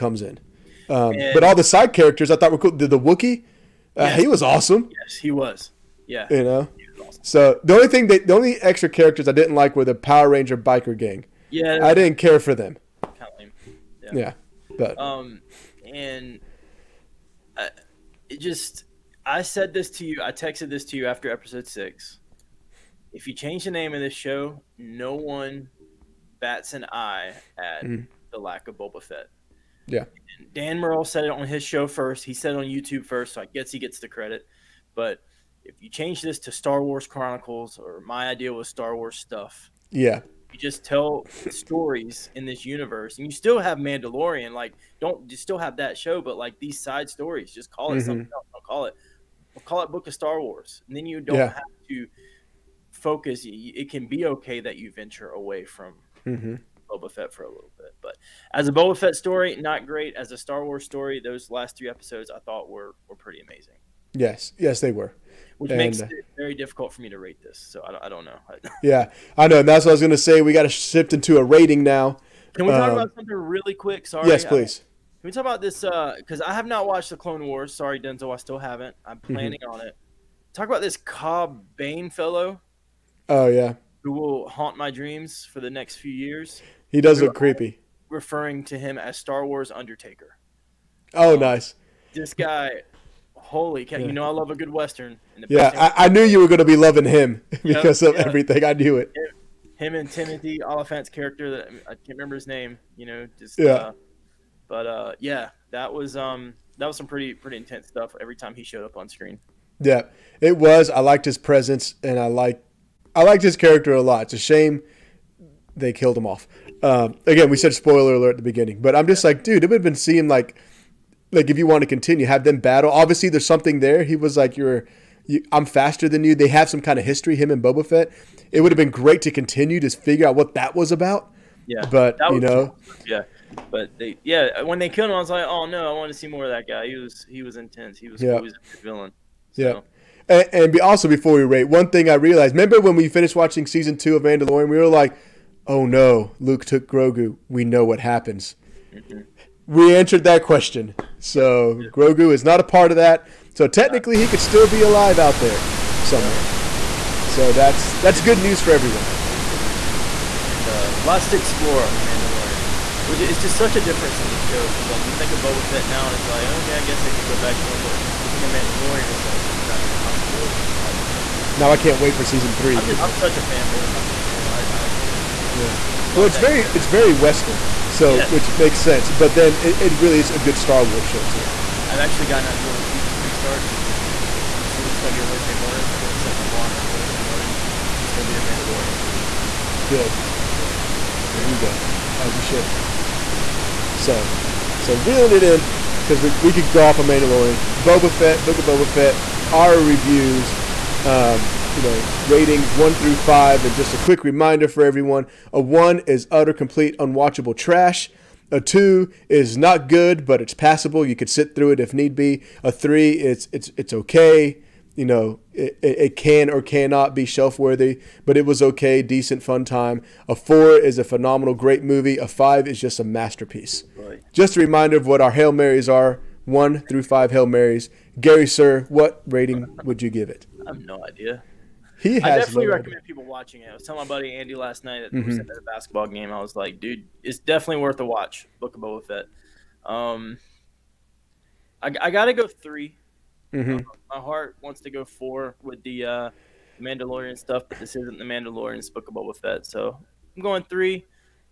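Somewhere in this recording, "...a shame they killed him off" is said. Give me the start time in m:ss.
1:54.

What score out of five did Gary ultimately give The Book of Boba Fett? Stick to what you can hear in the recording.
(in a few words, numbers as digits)
3.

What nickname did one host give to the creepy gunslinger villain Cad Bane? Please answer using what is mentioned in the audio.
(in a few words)
Star Wars Undertaker.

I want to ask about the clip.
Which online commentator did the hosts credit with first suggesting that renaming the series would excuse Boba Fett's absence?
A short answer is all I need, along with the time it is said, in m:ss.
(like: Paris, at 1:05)
Dan Murrell, at 0:30.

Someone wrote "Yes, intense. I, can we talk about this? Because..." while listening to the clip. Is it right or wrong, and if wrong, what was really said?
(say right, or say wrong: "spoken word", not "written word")
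wrong: "please", not "intense".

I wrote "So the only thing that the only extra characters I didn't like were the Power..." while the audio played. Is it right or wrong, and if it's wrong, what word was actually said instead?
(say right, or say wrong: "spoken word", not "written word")
right.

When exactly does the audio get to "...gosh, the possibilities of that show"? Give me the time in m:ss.
2:49.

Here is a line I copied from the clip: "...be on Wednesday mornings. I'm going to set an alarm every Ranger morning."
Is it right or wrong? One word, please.
wrong.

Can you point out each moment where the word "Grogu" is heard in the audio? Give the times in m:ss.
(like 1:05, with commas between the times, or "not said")
2:26, 2:31.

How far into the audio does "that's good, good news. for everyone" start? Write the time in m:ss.
2:38.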